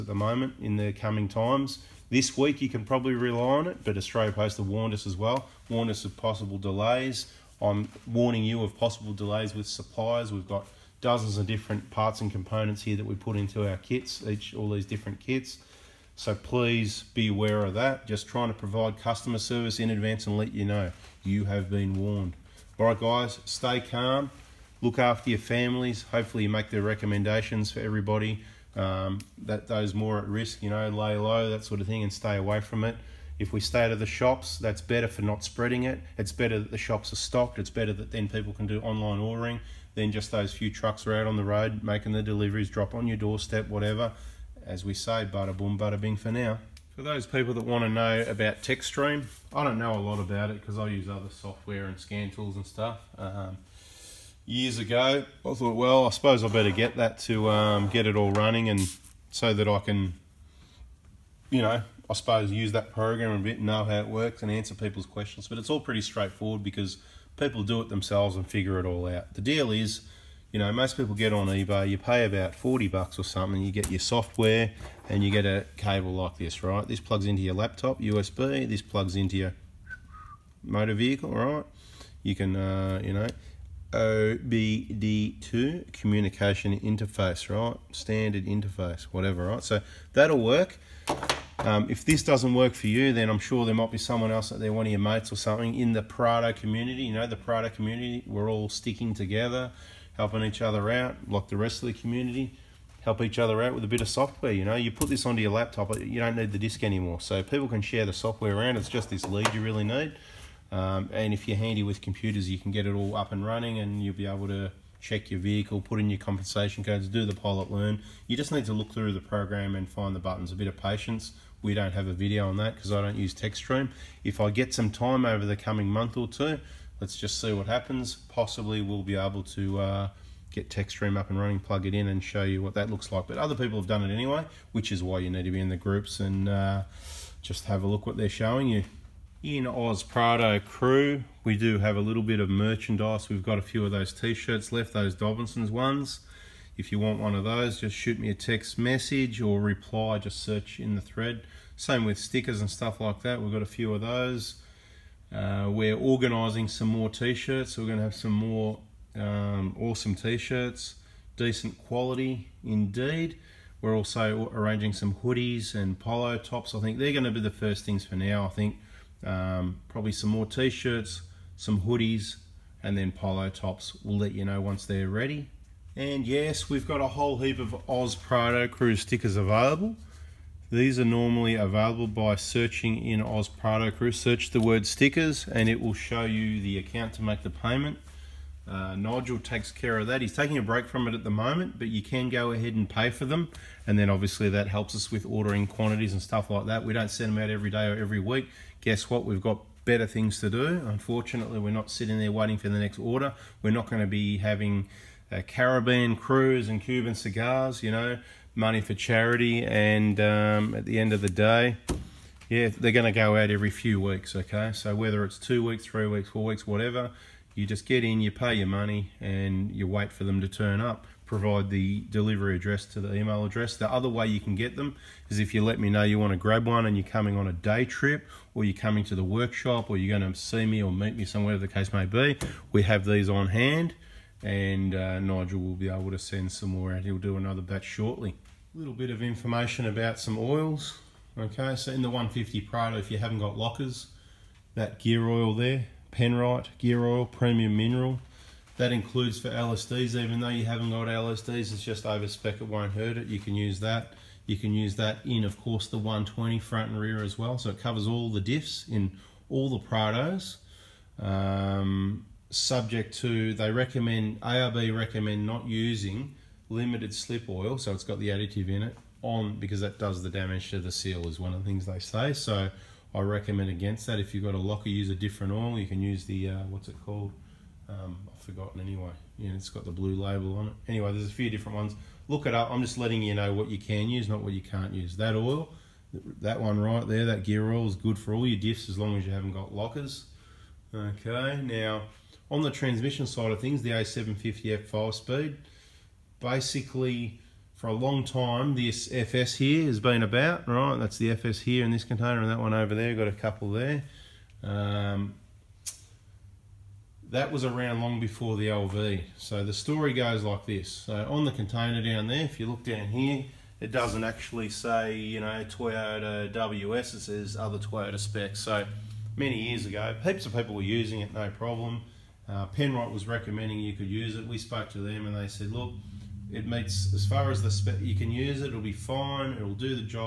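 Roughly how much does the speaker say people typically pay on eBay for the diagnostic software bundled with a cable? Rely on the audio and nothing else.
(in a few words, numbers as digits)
40 bucks.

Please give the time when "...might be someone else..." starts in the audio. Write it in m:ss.
1:33.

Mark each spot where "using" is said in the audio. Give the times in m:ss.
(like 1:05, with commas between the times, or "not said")
4:25, 5:20.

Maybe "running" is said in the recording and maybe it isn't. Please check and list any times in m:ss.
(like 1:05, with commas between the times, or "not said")
0:58, 1:53, 2:11.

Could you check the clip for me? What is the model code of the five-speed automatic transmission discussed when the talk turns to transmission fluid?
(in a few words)
A750F.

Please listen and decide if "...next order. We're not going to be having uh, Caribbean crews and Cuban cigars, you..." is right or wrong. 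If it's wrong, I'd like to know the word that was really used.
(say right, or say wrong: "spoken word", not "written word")
right.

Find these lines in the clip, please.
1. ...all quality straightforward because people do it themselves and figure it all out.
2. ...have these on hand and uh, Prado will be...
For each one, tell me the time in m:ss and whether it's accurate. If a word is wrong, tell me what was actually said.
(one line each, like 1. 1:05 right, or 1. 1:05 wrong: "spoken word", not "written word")
1. 1:05 wrong: "pretty", not "quality"
2. 3:52 wrong: "Nigel", not "Prado".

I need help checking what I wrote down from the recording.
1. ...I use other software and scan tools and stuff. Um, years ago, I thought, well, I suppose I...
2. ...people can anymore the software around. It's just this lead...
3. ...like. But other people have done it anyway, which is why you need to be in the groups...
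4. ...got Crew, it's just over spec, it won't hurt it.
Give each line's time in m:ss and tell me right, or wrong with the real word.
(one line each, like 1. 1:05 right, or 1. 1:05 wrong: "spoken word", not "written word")
1. 0:50 right
2. 1:47 wrong: "share", not "anymore"
3. 2:13 right
4. 4:10 wrong: "LSDs", not "Crew".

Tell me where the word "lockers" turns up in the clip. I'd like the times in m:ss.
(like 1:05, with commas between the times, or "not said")
4:03, 4:34, 4:49.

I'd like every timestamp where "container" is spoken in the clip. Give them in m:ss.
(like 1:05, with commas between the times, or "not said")
5:02, 5:11.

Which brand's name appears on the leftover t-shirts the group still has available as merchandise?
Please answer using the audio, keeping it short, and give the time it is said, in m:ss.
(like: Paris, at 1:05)
Dobinson's, at 2:25.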